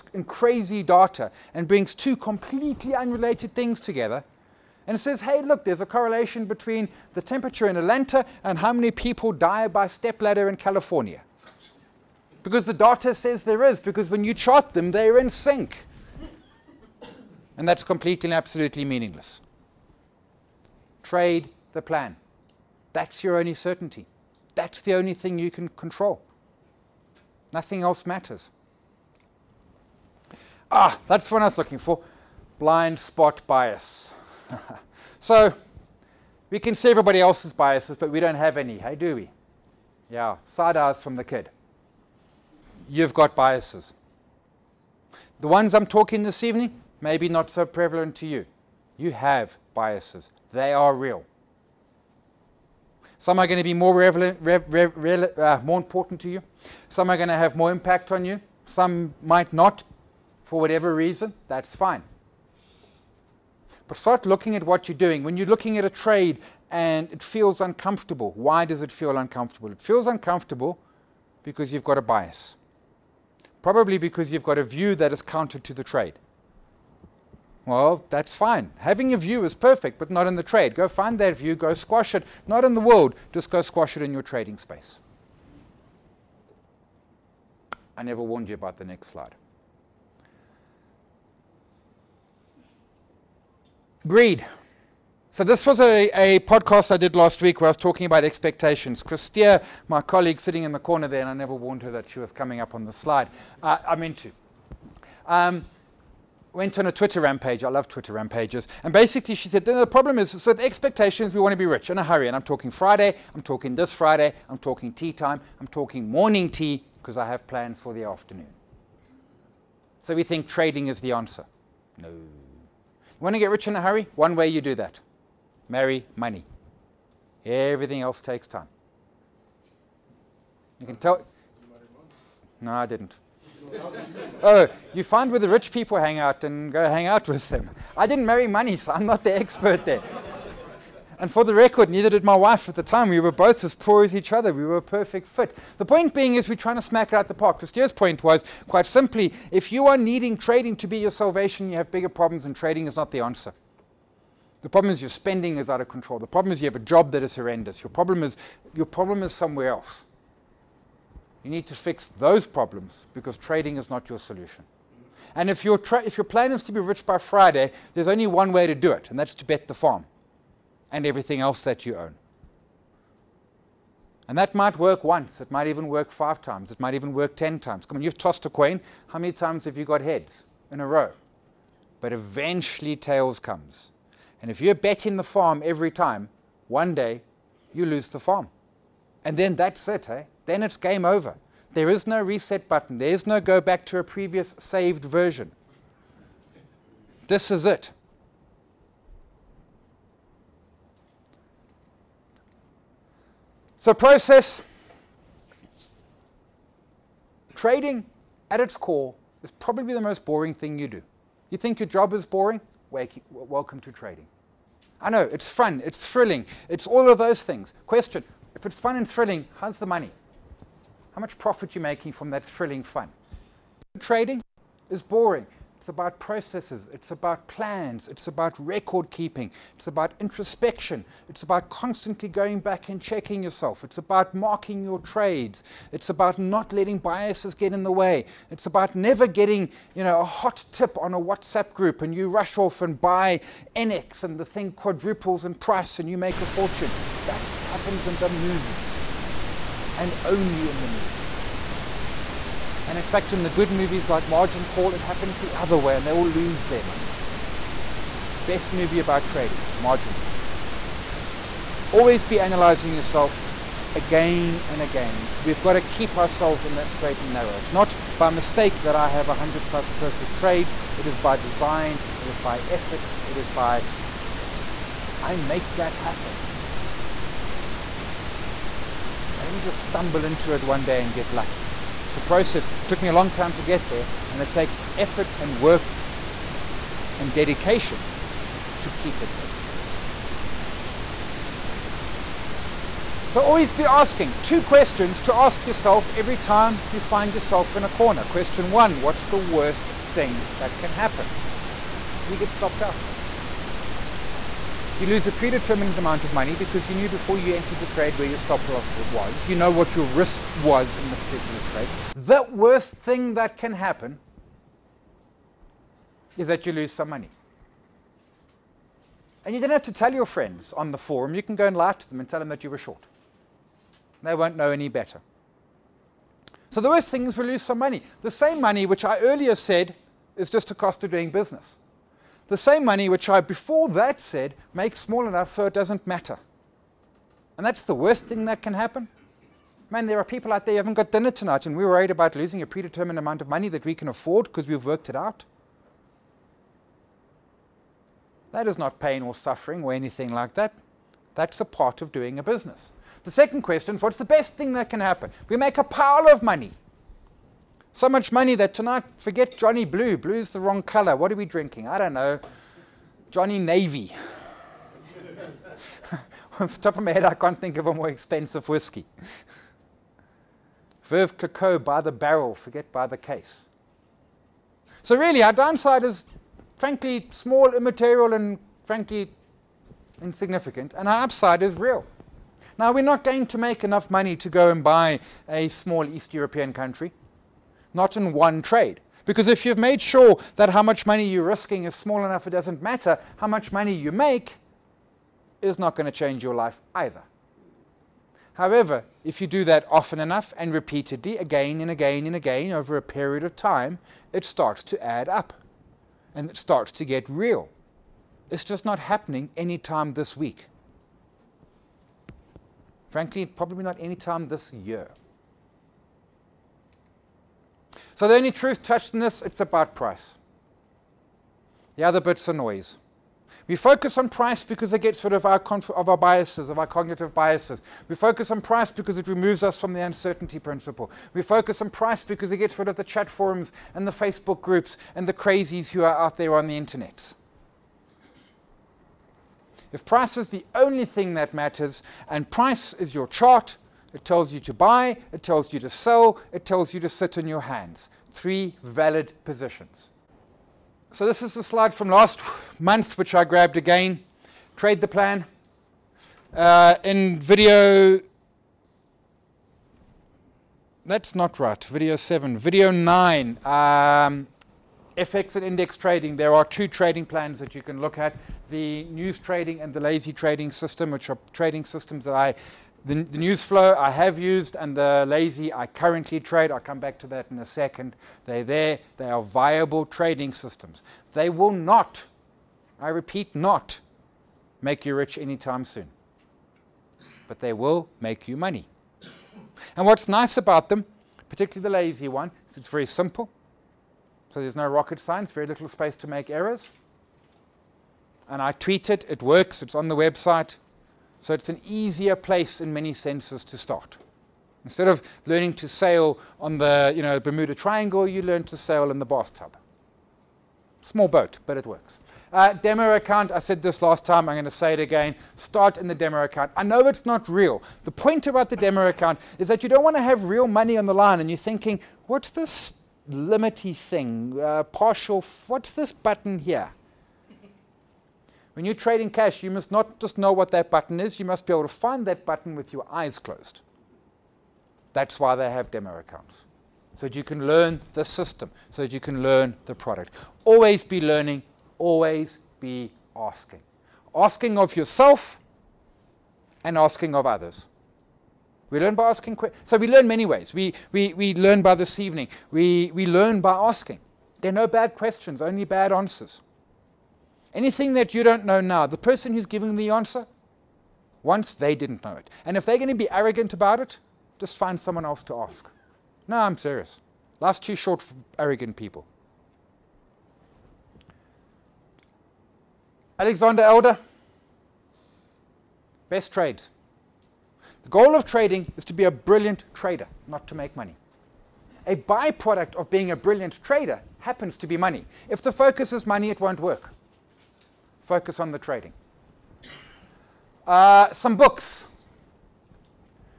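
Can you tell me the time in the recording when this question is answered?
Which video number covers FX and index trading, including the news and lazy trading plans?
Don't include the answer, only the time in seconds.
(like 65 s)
462 s.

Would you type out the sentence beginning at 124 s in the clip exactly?
One way you do that marry money.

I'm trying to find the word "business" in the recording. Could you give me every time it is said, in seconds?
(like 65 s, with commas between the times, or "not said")
331 s, 352 s.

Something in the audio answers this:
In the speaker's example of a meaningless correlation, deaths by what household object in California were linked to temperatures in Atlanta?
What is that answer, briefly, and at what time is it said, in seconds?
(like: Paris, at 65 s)
Stepladder, at 9 s.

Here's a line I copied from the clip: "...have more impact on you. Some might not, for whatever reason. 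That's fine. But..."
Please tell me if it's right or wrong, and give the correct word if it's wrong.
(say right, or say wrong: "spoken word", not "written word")
right.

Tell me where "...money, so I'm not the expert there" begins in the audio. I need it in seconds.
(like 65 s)
138 s.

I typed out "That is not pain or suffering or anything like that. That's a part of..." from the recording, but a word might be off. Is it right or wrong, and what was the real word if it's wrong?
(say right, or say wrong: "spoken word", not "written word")
right.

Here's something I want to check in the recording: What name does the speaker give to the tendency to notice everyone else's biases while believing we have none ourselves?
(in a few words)
Blind spot bias.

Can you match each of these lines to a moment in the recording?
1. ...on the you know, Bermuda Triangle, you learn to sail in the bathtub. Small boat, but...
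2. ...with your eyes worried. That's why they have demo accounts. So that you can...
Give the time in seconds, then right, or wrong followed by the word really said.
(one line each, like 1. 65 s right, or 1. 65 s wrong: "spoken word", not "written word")
1. 506 s right
2. 532 s wrong: "closed", not "worried".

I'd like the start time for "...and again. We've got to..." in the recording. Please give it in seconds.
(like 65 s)
264 s.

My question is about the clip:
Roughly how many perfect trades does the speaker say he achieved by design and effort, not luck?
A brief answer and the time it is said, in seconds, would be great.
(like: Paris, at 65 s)
100 plus, at 269 s.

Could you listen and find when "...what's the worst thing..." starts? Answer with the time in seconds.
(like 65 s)
298 s.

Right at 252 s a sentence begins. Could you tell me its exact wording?
And in fact, in the good movies like Margin Call, it happens the other way and they all lose their money.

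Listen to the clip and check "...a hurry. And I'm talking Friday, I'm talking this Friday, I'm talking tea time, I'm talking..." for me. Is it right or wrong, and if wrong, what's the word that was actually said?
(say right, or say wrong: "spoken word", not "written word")
right.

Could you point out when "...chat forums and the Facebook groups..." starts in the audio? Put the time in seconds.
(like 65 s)
433 s.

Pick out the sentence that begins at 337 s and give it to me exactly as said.
And that's the worst thing that can happen.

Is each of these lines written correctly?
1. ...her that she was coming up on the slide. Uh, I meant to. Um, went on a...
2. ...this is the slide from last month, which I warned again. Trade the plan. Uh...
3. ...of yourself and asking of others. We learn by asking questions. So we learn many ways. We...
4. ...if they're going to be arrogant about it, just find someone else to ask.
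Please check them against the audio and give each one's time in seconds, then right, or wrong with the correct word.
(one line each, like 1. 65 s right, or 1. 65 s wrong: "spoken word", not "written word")
1. 101 s right
2. 451 s wrong: "grabbed", not "warned"
3. 544 s right
4. 562 s right.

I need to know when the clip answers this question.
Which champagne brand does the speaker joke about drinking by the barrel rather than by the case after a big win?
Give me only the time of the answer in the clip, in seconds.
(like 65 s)
371 s.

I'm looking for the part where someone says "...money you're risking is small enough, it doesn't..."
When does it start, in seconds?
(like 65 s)
391 s.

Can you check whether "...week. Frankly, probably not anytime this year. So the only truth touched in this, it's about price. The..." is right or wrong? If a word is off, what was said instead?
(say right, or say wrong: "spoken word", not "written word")
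right.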